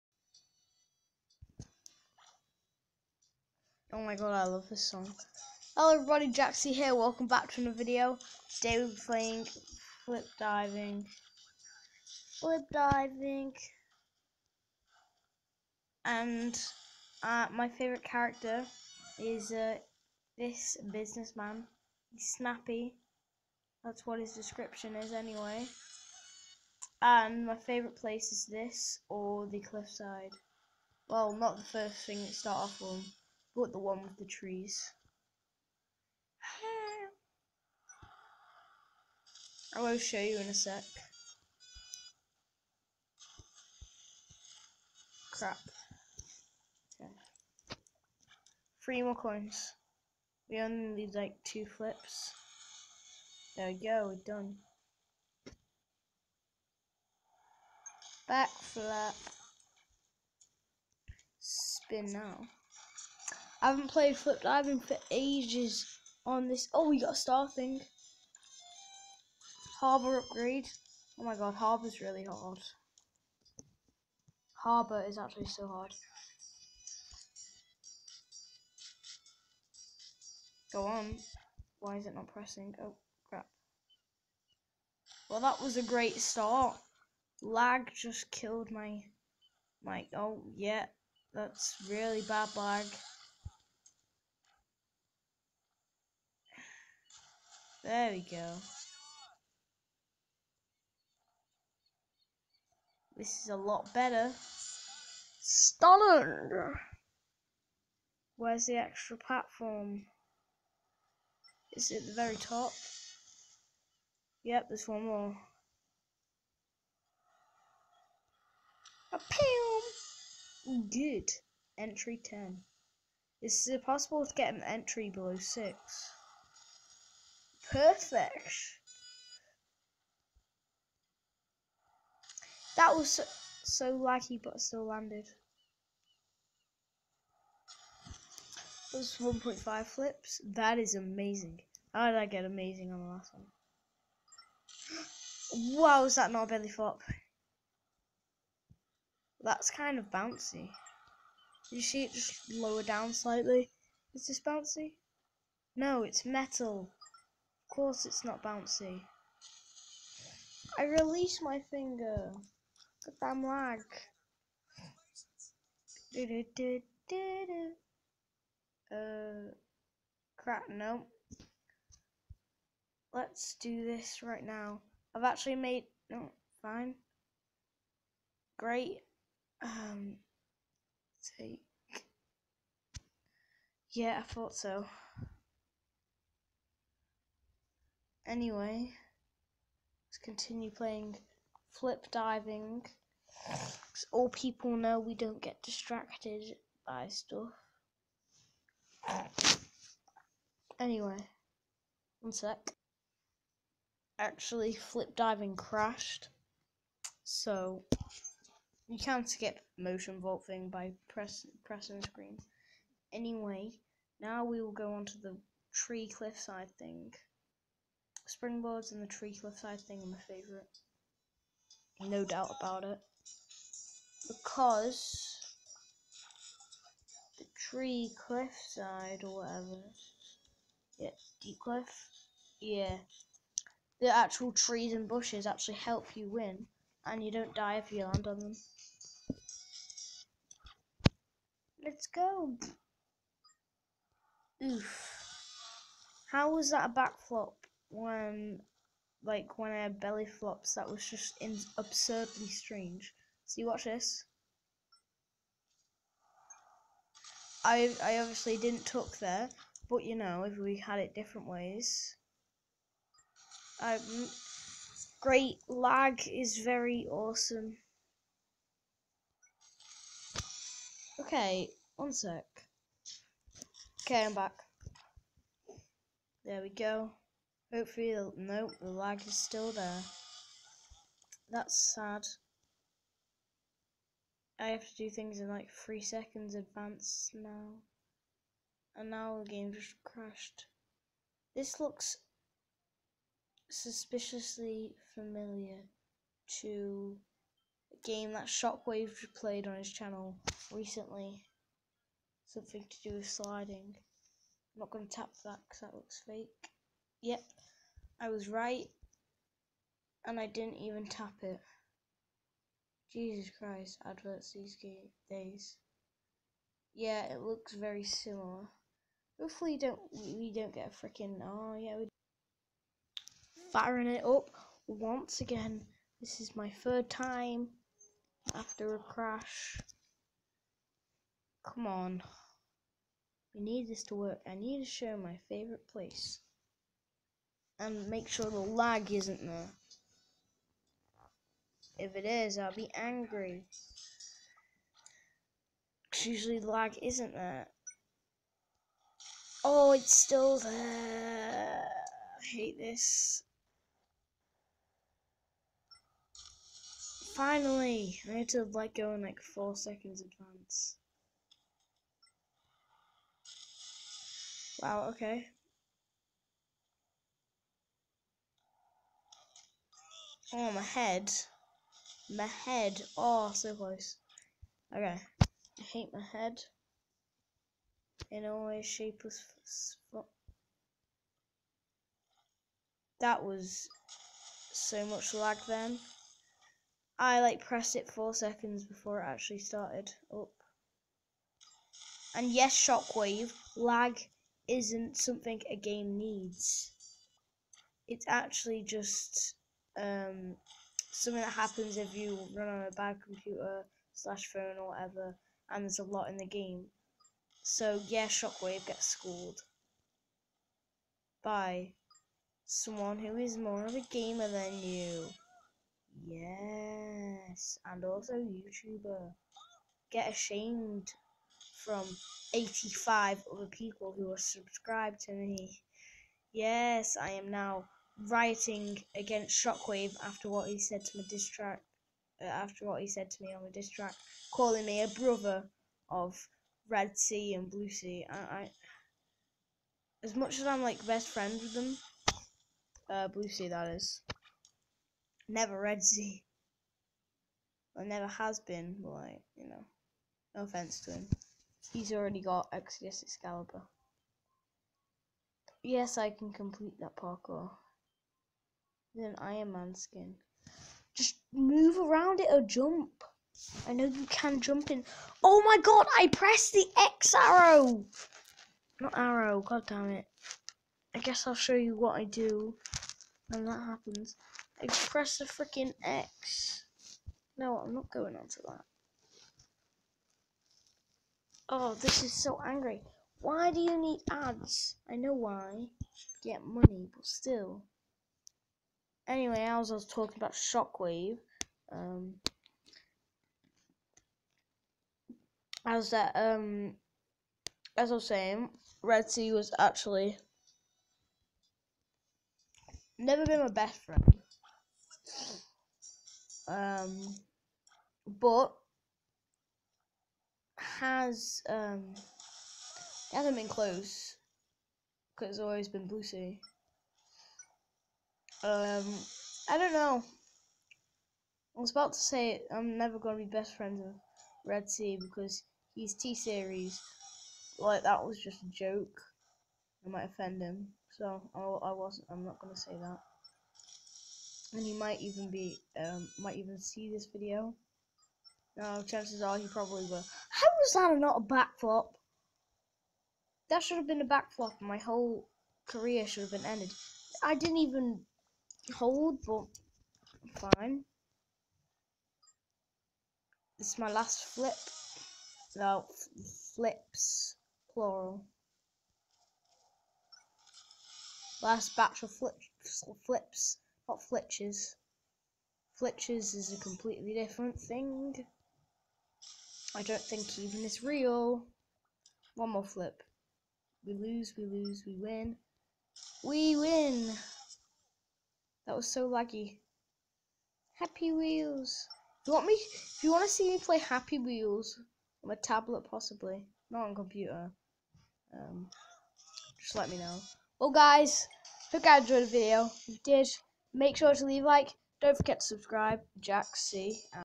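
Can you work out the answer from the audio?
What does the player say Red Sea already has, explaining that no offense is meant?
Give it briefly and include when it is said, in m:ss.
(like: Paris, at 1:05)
Exodus Excalibur, at 7:32.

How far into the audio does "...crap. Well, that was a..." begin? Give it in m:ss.
1:23.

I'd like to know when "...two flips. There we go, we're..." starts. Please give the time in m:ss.
0:51.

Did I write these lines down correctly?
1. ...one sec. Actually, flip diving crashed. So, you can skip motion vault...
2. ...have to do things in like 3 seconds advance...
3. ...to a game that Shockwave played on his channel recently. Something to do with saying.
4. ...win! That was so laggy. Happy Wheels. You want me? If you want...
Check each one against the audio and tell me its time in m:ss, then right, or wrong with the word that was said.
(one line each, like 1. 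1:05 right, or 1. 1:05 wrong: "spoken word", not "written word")
1. 3:22 right
2. 4:44 right
3. 4:56 wrong: "sliding", not "saying"
4. 9:36 right.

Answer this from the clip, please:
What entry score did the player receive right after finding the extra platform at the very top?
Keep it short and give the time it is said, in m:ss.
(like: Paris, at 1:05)
10, at 2:01.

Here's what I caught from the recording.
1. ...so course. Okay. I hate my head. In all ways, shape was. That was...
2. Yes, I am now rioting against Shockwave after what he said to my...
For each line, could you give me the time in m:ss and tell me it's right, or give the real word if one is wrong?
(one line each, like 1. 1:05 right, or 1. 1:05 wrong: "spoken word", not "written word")
1. 6:13 wrong: "close", not "course"
2. 7:06 right.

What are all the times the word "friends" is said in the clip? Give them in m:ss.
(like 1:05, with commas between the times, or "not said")
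7:21, 8:24, 8:43.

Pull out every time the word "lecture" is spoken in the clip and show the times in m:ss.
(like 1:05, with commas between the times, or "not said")
not said.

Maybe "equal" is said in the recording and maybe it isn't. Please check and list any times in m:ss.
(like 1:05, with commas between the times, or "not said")
not said.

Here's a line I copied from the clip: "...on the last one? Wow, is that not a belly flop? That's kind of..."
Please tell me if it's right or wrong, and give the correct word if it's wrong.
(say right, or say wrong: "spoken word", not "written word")
right.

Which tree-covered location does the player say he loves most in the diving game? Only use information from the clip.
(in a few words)
Deep cliff.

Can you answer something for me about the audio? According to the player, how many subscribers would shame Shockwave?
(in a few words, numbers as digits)
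85.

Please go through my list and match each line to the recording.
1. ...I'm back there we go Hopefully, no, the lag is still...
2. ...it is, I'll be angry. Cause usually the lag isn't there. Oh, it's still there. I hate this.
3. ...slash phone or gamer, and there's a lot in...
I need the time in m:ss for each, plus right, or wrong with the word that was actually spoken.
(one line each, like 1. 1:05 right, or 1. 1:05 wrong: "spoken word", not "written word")
1. 4:34 right
2. 5:42 right
3. 6:44 wrong: "whatever", not "gamer".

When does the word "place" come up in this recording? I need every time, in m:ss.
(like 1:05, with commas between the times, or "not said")
0:27, 5:35.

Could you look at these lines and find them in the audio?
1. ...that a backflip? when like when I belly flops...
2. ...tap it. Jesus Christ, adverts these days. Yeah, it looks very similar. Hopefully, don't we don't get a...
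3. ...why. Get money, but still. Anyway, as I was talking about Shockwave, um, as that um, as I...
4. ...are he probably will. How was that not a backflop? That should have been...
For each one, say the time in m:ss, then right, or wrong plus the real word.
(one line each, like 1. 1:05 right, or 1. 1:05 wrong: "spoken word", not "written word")
1. 4:06 right
2. 5:11 right
3. 8:05 right
4. 8:59 right.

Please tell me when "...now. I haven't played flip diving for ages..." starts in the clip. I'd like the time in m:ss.
1:02.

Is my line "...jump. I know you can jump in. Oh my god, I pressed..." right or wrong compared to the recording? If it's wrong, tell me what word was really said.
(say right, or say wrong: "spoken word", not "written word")
right.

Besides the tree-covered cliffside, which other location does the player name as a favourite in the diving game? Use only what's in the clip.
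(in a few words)
Springboards.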